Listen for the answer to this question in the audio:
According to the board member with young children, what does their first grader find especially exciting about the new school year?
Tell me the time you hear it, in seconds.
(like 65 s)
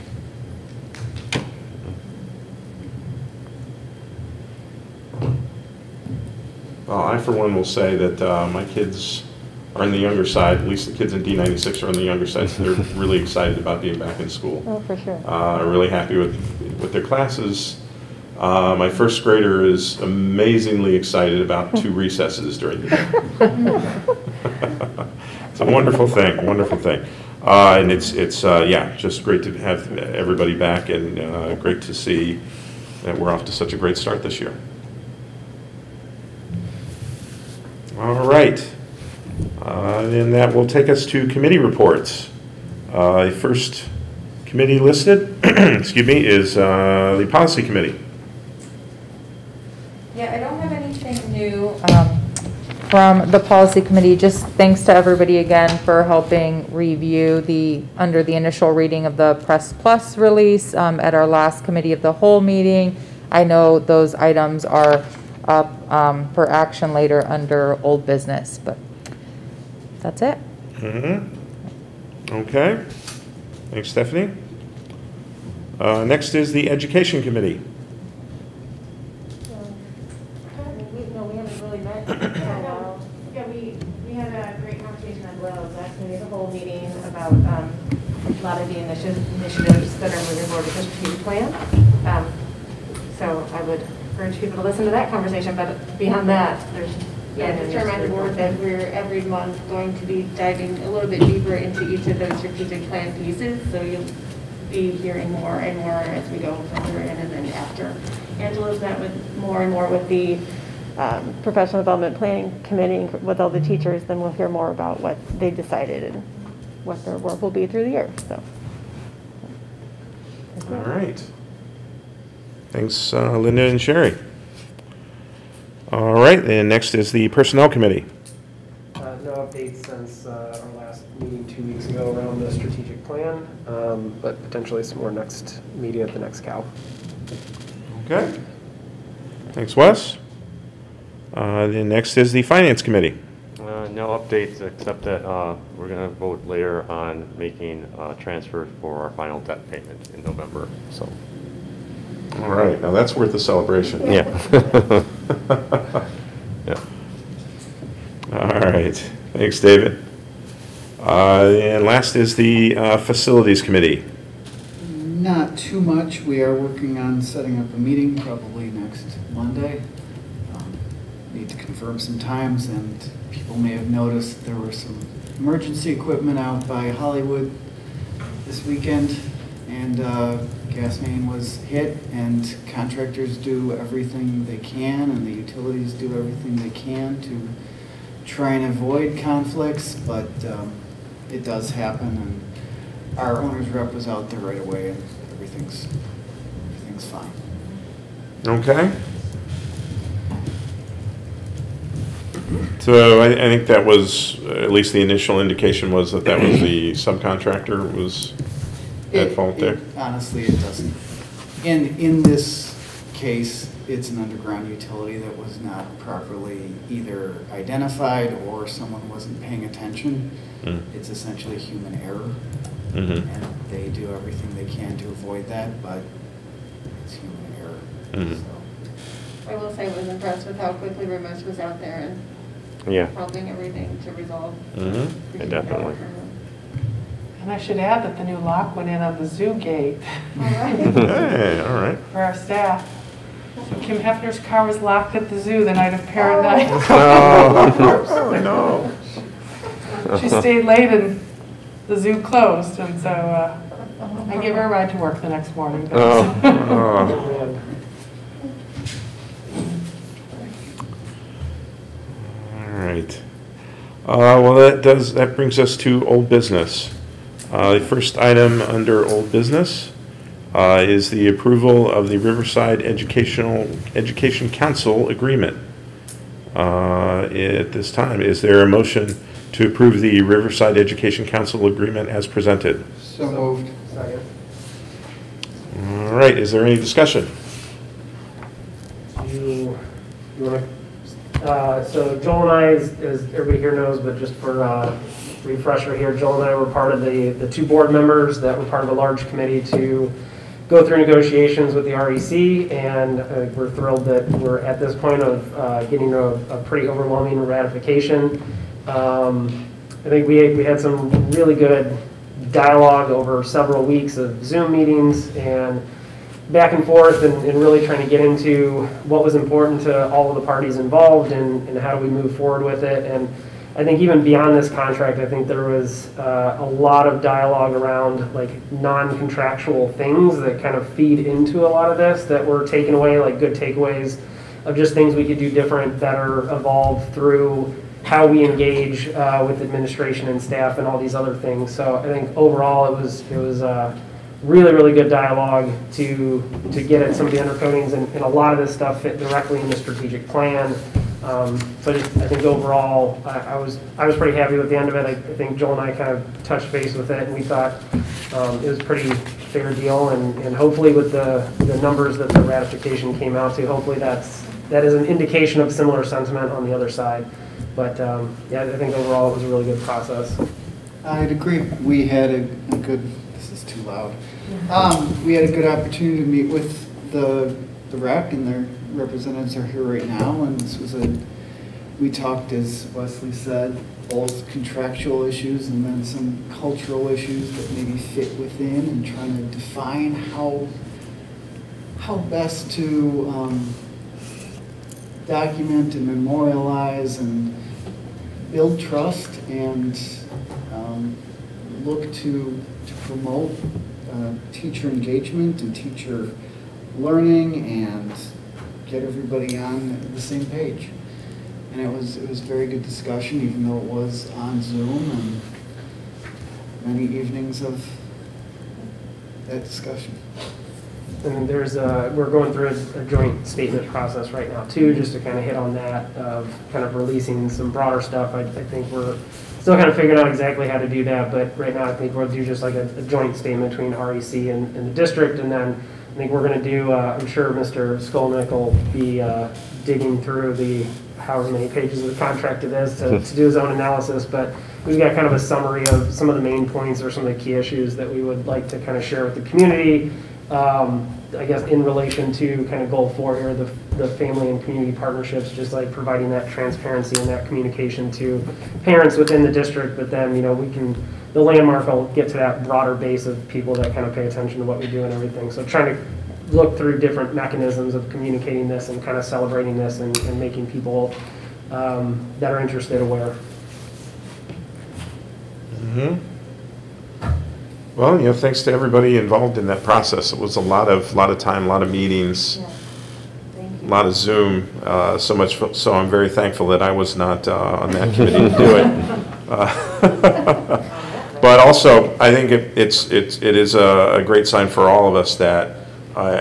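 21 s.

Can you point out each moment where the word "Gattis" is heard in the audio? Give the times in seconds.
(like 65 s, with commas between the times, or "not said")
not said.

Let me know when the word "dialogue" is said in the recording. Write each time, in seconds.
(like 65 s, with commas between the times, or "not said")
312 s, 327 s, 345 s.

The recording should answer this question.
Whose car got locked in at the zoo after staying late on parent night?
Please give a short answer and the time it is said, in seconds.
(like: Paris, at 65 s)
Kim Hefner, at 243 s.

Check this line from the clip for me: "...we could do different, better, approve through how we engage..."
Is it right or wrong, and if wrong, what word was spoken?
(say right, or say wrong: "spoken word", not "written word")
wrong: "evolve", not "approve".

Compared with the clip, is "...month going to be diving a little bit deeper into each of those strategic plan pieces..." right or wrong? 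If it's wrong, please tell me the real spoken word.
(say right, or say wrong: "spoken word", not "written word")
right.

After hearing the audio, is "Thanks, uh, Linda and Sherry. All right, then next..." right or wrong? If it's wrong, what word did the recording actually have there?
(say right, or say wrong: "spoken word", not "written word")
right.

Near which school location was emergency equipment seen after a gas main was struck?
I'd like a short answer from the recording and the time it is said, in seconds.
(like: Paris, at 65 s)
Hollywood, at 176 s.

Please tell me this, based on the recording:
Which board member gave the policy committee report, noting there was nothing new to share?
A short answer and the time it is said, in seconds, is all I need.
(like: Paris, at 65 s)
Stephanie, at 73 s.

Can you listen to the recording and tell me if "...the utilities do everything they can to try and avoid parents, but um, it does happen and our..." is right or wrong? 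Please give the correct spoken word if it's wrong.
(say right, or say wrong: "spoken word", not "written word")
wrong: "conflicts", not "parents".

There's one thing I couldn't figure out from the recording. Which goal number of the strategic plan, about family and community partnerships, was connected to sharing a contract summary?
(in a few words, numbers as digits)
4.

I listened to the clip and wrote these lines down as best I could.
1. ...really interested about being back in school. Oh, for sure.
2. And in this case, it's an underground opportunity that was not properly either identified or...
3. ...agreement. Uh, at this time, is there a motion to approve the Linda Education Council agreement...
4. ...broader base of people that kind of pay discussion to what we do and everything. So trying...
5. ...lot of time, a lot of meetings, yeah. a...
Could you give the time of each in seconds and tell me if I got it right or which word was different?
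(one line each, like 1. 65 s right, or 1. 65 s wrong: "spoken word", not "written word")
1. 12 s wrong: "excited", not "interested"
2. 211 s wrong: "utility", not "opportunity"
3. 275 s wrong: "Riverside", not "Linda"
4. 462 s wrong: "attention", not "discussion"
5. 481 s right.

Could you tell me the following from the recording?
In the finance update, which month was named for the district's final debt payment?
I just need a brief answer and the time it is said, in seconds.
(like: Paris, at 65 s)
November, at 150 s.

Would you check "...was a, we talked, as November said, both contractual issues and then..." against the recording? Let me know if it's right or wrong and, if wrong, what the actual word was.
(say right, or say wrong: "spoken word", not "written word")
wrong: "Wesley", not "November".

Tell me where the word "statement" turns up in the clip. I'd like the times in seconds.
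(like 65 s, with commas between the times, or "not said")
423 s, 433 s.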